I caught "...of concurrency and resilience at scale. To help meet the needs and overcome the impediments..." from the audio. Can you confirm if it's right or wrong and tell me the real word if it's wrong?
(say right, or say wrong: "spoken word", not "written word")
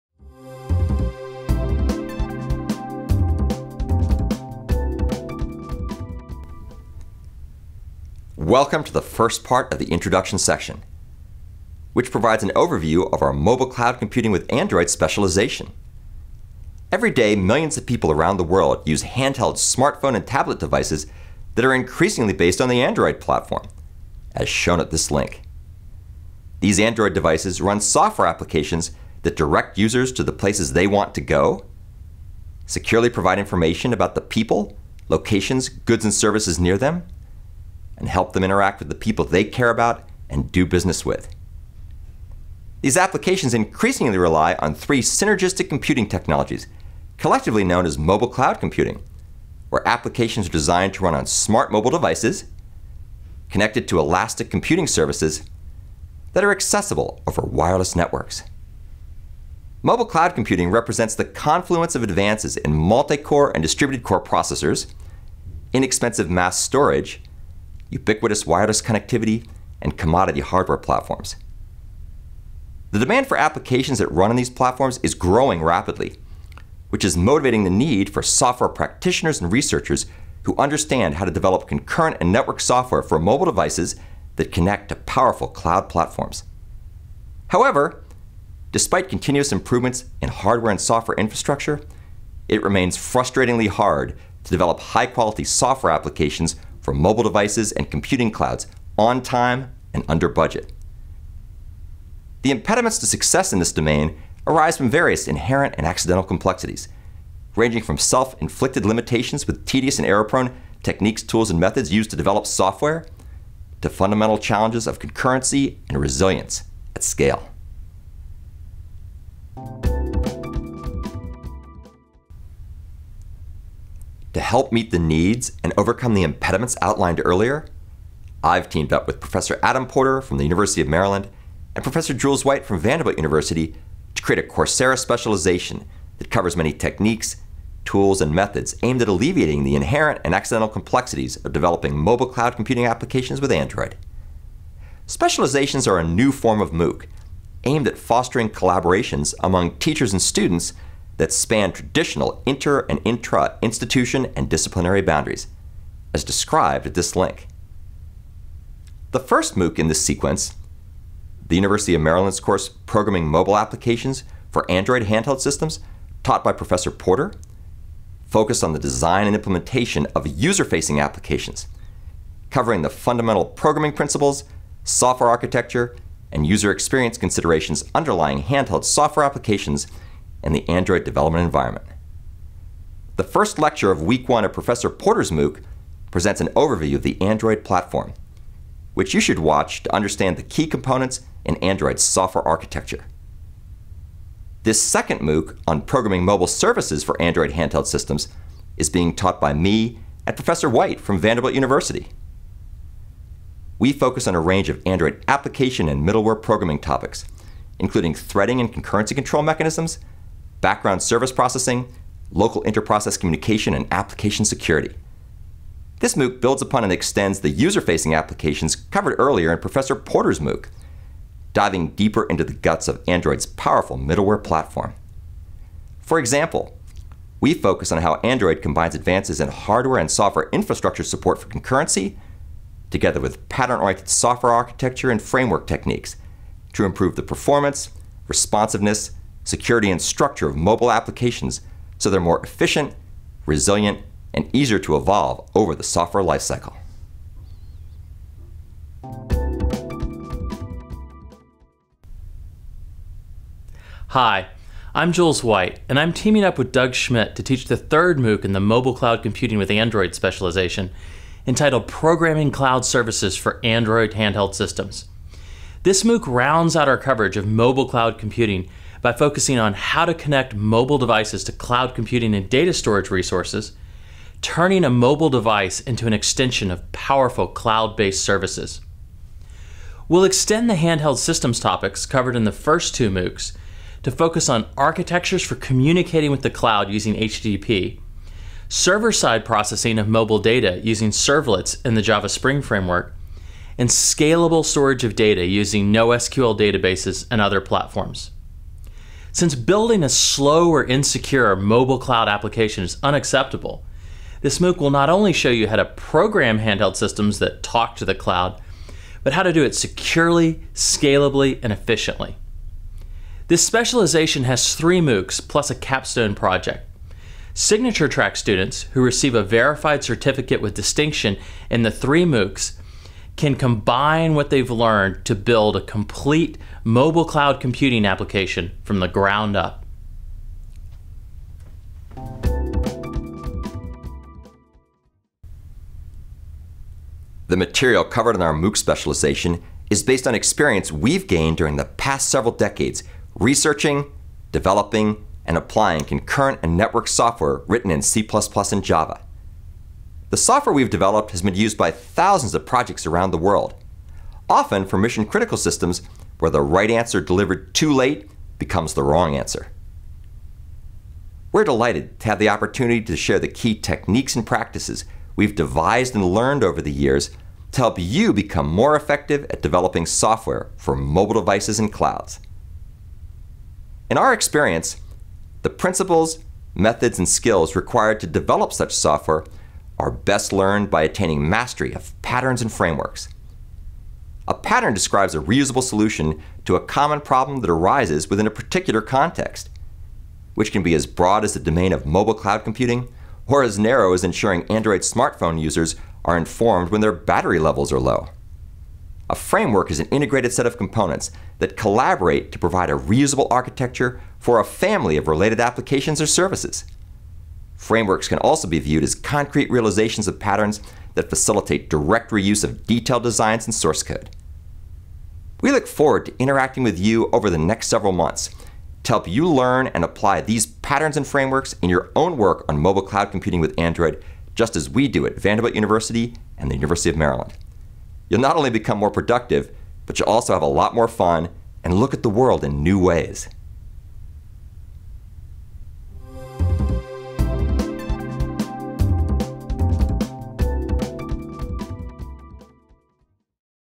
right.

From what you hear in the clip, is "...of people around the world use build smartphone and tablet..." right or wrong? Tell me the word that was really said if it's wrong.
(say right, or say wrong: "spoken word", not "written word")
wrong: "handheld", not "build".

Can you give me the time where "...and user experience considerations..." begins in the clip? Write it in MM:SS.
02:56.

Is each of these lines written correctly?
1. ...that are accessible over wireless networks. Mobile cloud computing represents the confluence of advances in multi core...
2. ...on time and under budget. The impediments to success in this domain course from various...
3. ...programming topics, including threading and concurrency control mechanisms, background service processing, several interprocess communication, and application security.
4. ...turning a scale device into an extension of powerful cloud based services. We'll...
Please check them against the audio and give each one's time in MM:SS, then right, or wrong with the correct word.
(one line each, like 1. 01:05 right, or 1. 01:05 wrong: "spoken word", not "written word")
1. 00:56 right
2. 01:38 wrong: "arise", not "course"
3. 03:26 wrong: "local", not "several"
4. 04:34 wrong: "mobile", not "scale".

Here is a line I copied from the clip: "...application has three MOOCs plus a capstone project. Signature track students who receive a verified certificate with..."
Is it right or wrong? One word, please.
wrong.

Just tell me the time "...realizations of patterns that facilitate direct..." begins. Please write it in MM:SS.
06:49.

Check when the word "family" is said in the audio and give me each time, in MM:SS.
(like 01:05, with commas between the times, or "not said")
06:44.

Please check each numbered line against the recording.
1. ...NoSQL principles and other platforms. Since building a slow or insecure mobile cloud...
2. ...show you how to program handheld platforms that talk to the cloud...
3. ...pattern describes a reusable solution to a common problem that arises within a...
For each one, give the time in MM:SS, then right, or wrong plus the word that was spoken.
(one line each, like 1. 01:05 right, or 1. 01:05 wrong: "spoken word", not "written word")
1. 04:55 wrong: "databases", not "principles"
2. 05:05 wrong: "systems", not "platforms"
3. 06:24 right.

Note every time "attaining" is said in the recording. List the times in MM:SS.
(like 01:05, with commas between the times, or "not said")
06:21.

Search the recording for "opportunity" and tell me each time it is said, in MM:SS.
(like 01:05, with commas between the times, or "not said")
06:02.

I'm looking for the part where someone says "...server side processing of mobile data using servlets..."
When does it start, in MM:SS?
04:48.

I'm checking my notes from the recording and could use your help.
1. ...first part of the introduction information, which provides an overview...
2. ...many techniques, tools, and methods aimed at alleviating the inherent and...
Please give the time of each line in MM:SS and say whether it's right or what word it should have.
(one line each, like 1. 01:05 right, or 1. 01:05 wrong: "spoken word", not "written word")
1. 00:09 wrong: "section", not "information"
2. 02:16 right.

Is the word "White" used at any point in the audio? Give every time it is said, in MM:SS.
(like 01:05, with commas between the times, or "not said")
02:12, 03:20, 04:15.